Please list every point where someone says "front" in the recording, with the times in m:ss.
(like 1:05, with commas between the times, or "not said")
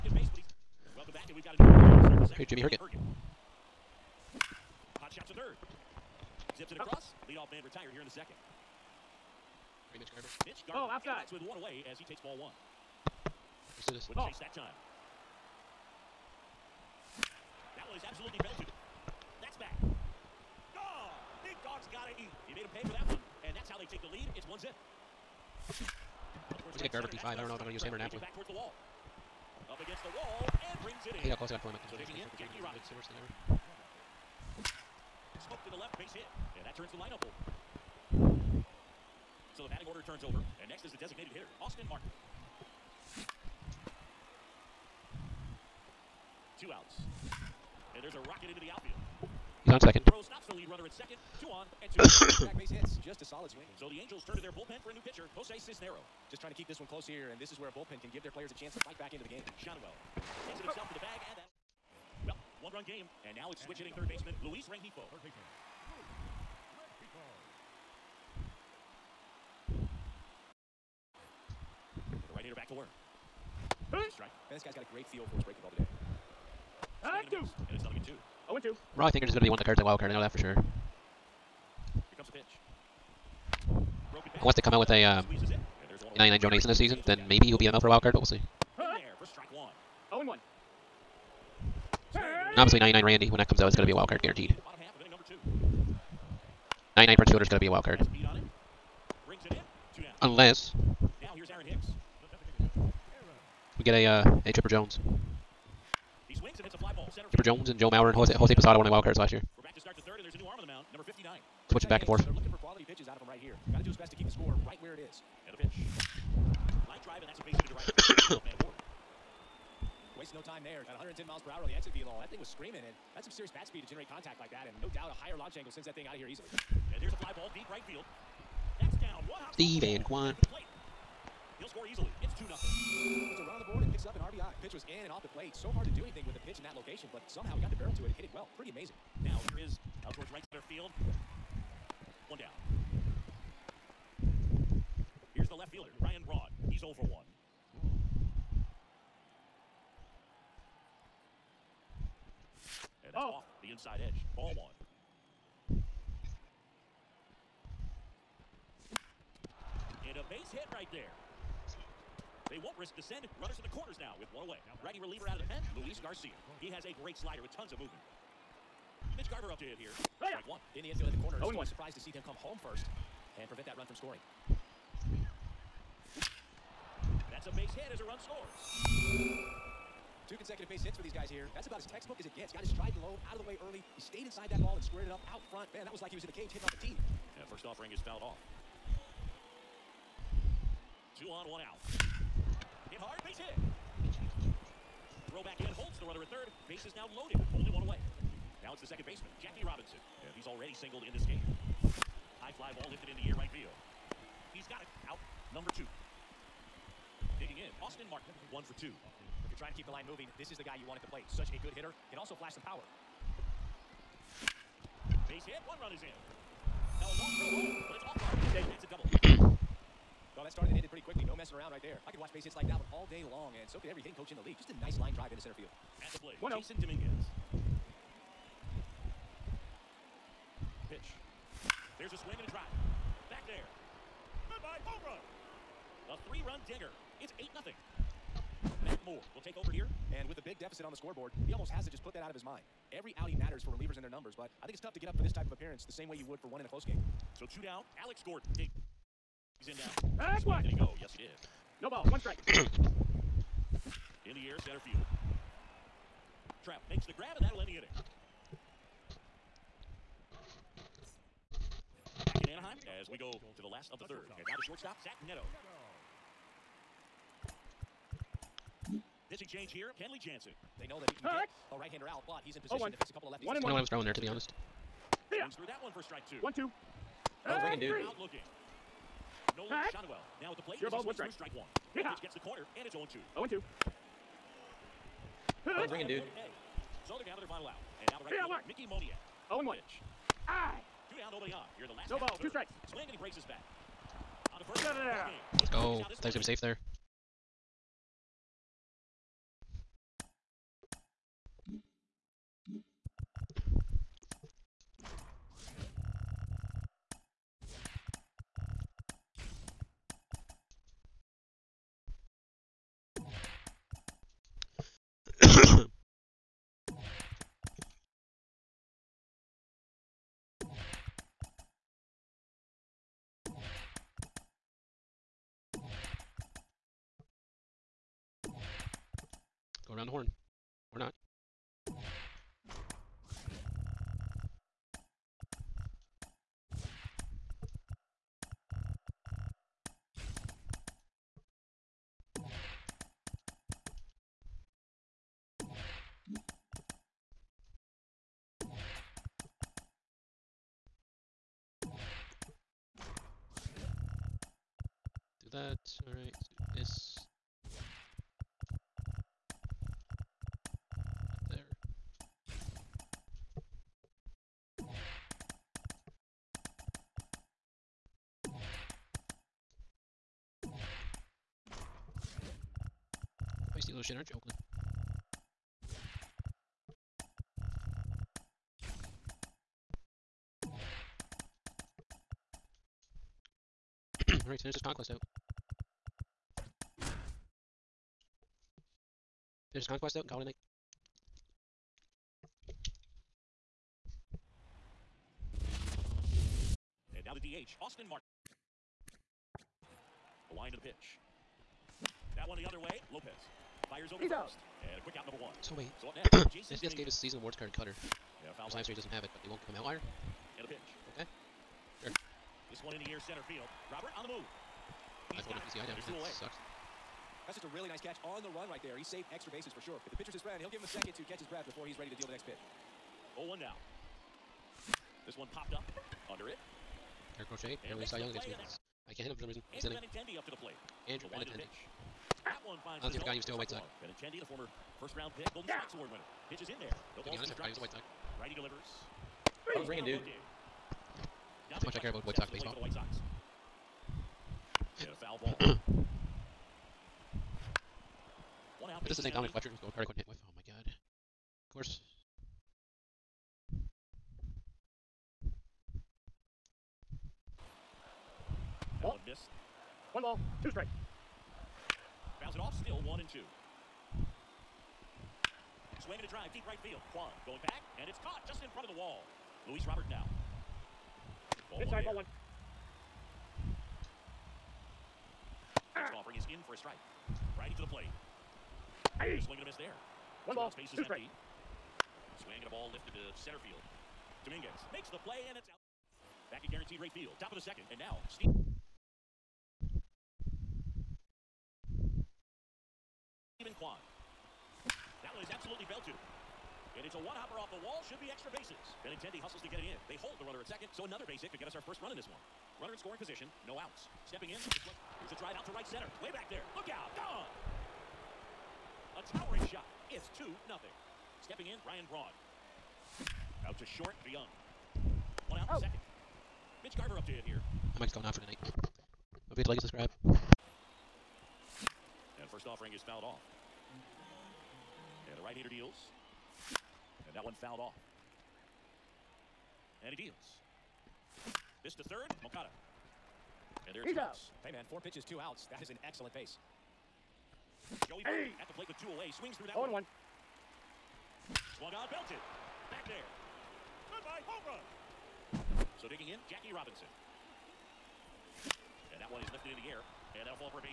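3:05, 7:48.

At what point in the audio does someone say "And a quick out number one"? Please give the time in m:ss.
6:44.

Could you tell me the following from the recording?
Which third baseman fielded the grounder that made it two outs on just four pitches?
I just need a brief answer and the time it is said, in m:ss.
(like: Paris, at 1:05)
Moncada, at 8:52.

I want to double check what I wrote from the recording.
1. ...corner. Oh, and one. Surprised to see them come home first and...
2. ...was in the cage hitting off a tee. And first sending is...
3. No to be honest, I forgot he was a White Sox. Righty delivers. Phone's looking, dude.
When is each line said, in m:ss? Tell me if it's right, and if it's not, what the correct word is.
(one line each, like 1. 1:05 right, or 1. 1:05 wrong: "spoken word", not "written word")
1. 2:51 right
2. 3:06 wrong: "offering", not "sending"
3. 7:17 wrong: "ringing", not "looking".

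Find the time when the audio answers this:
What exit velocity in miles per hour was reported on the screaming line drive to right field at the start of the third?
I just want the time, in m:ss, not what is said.
2:00.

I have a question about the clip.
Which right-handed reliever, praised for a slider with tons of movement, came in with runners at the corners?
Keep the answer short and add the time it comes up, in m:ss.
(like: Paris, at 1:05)
Luis Garcia, at 2:45.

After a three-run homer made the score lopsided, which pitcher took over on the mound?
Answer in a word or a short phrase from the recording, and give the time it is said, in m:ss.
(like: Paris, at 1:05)
Matt Moore, at 3:58.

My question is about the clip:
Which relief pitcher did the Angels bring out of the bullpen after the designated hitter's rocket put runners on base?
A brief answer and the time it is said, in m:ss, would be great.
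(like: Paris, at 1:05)
Jose Cisnero, at 0:55.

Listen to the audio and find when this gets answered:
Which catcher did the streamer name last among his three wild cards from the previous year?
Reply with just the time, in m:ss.
1:48.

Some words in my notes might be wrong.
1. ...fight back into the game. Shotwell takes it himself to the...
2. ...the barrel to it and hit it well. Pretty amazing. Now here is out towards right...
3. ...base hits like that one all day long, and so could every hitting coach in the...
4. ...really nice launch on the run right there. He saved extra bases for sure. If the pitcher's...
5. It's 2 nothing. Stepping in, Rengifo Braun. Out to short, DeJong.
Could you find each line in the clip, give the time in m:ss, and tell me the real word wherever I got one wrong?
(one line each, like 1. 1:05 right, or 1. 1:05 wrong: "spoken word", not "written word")
1. 0:58 right
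2. 2:17 right
3. 3:42 right
4. 6:57 wrong: "catch", not "launch"
5. 8:30 wrong: "Ryan", not "Rengifo".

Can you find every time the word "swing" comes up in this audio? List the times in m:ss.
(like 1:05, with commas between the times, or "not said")
0:53, 3:52, 4:35, 4:52, 7:46, 7:59, 8:59.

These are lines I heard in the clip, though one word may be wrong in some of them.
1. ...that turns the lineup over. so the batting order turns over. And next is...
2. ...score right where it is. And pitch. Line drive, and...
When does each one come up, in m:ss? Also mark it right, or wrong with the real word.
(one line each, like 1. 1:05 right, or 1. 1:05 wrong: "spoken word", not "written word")
1. 0:36 right
2. 1:54 right.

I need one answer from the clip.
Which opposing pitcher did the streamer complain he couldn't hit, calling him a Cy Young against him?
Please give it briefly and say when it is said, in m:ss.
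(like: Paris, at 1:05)
Garrett Crochet, at 7:07.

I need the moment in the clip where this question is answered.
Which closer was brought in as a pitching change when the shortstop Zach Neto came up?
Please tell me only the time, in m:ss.
4:29.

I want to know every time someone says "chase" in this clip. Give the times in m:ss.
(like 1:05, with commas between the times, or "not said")
0:14.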